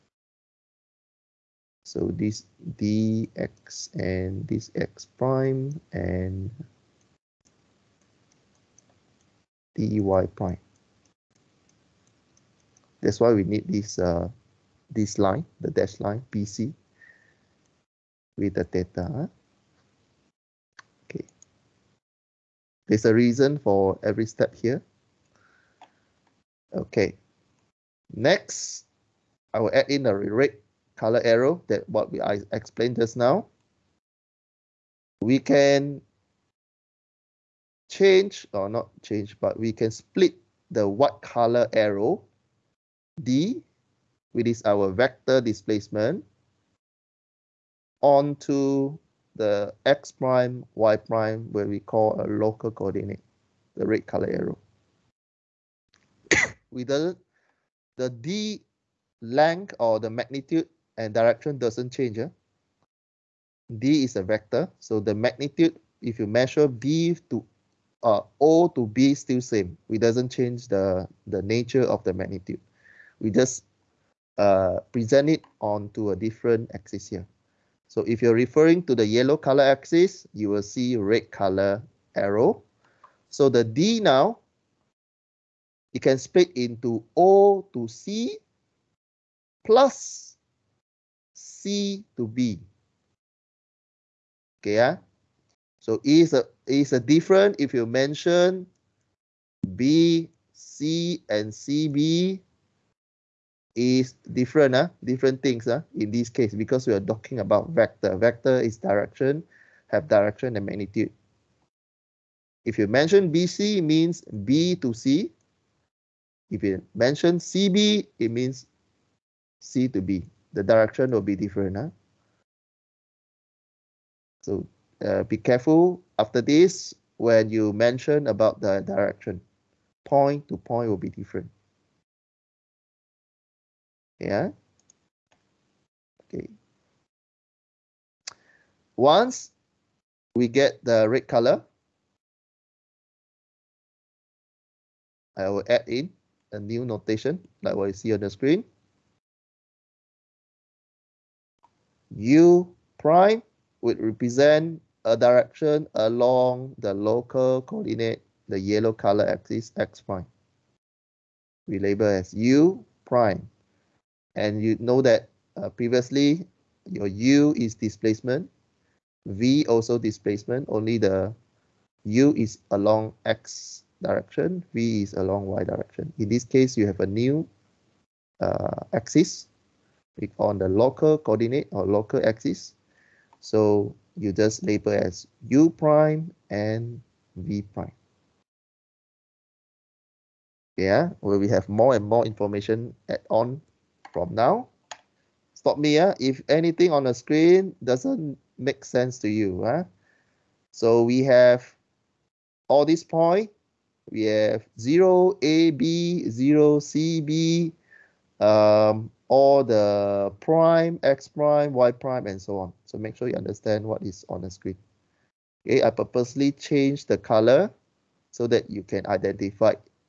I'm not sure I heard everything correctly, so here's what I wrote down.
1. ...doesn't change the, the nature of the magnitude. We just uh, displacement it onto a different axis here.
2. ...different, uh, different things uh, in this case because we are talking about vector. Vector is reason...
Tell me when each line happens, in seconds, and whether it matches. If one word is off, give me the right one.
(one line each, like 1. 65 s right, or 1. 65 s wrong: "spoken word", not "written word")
1. 69 s wrong: "present", not "displacement"
2. 104 s wrong: "direction", not "reason".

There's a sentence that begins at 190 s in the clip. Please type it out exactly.
Yeah, where we have more and more information add on from now.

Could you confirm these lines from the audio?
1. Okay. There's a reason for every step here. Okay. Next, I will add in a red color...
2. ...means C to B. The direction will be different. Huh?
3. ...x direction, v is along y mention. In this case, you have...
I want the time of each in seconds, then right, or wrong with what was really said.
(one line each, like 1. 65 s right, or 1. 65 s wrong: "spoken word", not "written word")
1. 21 s right
2. 118 s right
3. 173 s wrong: "direction", not "mention".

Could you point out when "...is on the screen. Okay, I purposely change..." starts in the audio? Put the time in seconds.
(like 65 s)
214 s.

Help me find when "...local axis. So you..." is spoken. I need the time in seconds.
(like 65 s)
181 s.